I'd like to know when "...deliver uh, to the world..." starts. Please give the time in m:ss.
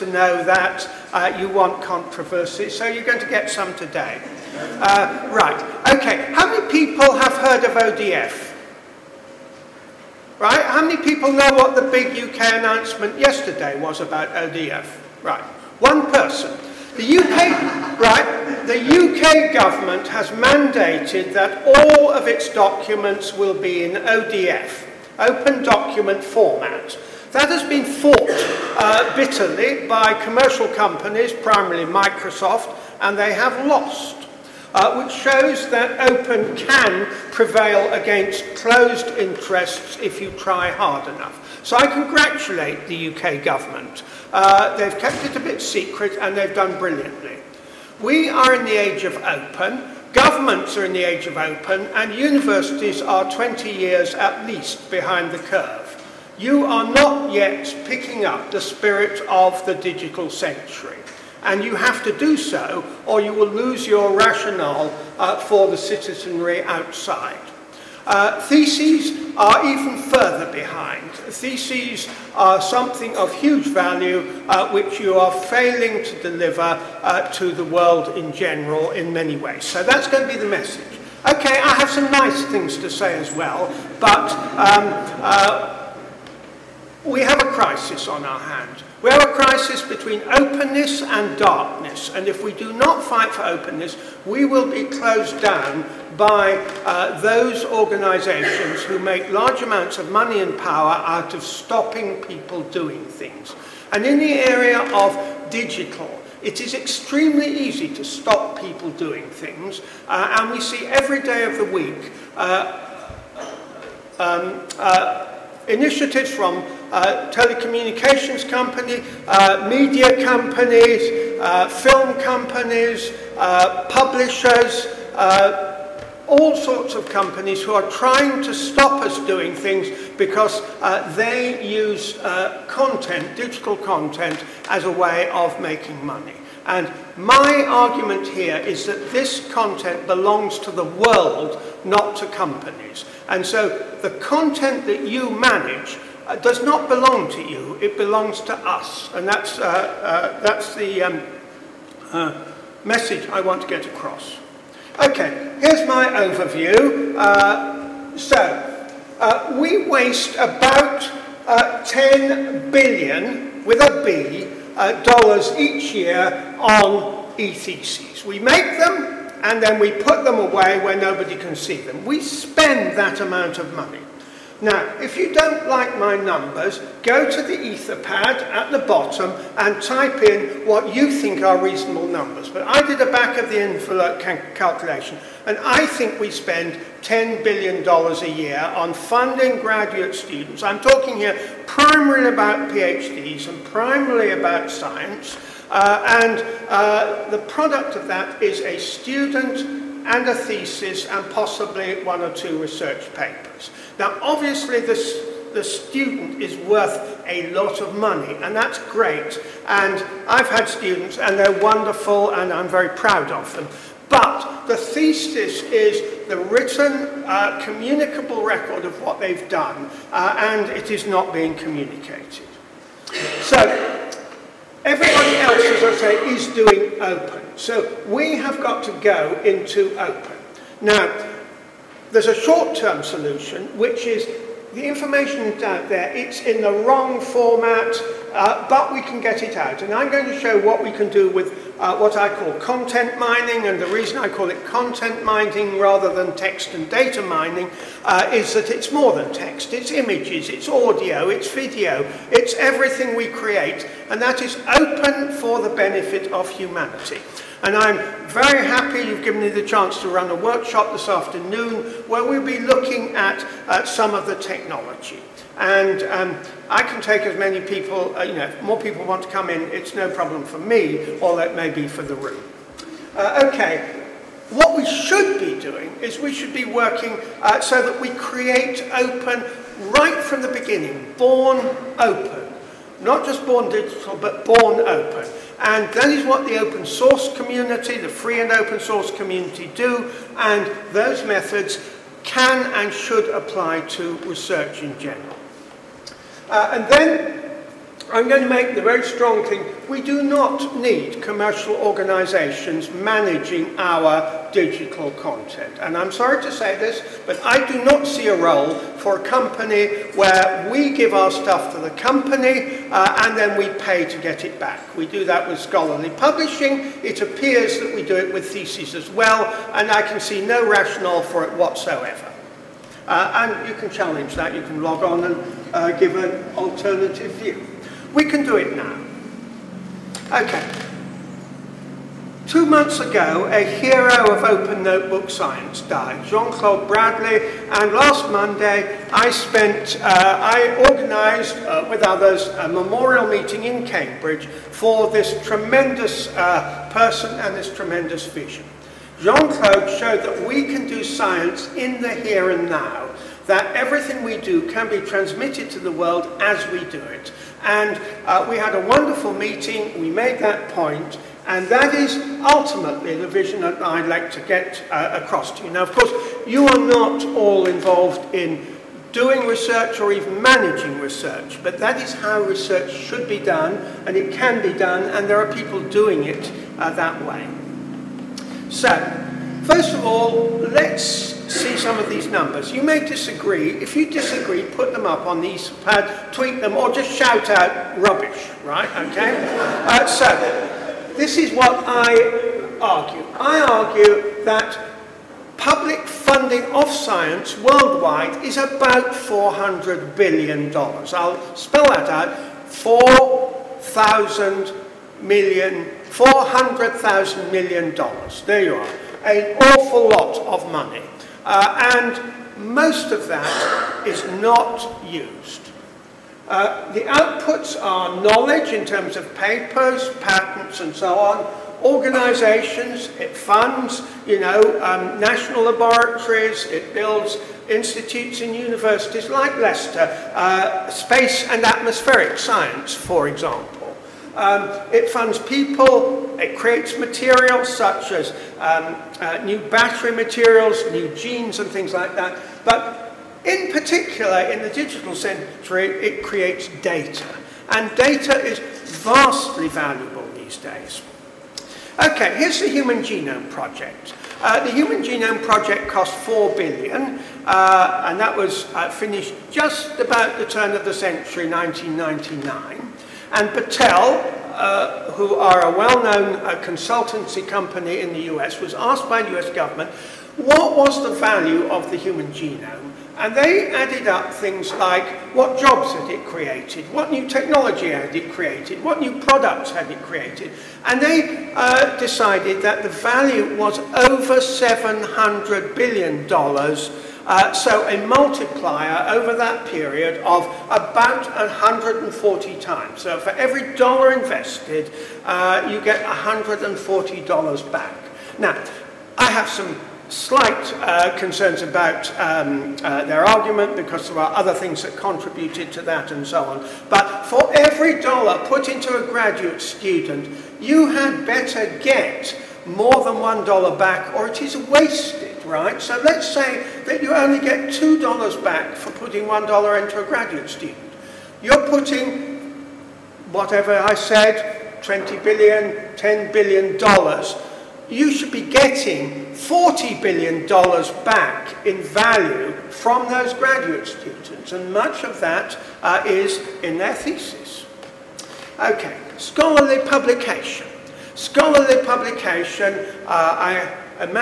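1:16.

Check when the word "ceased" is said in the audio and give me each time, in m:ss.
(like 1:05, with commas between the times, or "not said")
not said.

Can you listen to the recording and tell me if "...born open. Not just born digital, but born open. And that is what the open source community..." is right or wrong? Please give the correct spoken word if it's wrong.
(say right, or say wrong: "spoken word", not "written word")
right.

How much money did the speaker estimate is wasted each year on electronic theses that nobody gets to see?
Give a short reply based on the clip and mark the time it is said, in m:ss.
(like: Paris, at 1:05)
$10 billion, at 2:41.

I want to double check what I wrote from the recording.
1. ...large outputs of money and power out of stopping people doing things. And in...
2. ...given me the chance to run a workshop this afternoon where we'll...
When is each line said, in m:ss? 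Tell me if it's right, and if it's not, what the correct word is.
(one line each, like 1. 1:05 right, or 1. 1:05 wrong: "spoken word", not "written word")
1. 1:39 wrong: "amounts", not "outputs"
2. 4:19 right.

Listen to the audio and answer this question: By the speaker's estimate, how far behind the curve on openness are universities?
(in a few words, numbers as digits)
20 years.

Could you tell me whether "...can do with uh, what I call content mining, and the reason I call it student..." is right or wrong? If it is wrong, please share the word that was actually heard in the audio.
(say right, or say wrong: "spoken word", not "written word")
wrong: "content", not "student".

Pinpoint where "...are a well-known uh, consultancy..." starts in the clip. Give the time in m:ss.
7:45.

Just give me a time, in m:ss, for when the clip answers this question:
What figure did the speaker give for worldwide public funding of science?
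6:39.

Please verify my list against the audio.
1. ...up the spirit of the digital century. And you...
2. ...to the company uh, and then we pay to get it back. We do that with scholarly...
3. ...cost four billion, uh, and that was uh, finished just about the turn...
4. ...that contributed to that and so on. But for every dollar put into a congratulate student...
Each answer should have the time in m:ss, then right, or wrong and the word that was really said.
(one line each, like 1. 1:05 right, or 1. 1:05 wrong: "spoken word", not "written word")
1. 0:58 right
2. 5:11 right
3. 7:35 right
4. 8:24 wrong: "graduate", not "congratulate".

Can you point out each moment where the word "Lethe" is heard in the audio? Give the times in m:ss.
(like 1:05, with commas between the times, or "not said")
not said.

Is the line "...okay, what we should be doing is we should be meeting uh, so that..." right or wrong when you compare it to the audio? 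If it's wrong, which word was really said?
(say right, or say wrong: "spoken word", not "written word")
wrong: "working", not "meeting".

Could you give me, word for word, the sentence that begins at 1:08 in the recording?
Uh, theses are even further behind.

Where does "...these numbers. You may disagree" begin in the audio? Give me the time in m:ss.
6:22.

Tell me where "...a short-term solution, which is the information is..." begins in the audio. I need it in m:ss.
3:52.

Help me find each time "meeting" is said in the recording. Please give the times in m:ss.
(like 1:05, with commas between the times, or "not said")
5:43, 5:59.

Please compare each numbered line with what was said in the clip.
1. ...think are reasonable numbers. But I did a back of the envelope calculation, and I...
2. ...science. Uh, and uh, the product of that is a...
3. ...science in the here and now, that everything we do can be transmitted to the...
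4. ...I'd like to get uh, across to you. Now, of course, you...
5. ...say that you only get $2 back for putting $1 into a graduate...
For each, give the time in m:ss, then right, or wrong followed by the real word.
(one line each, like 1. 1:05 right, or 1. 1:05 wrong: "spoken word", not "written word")
1. 3:01 right
2. 3:14 right
3. 5:51 right
4. 6:03 right
5. 8:36 right.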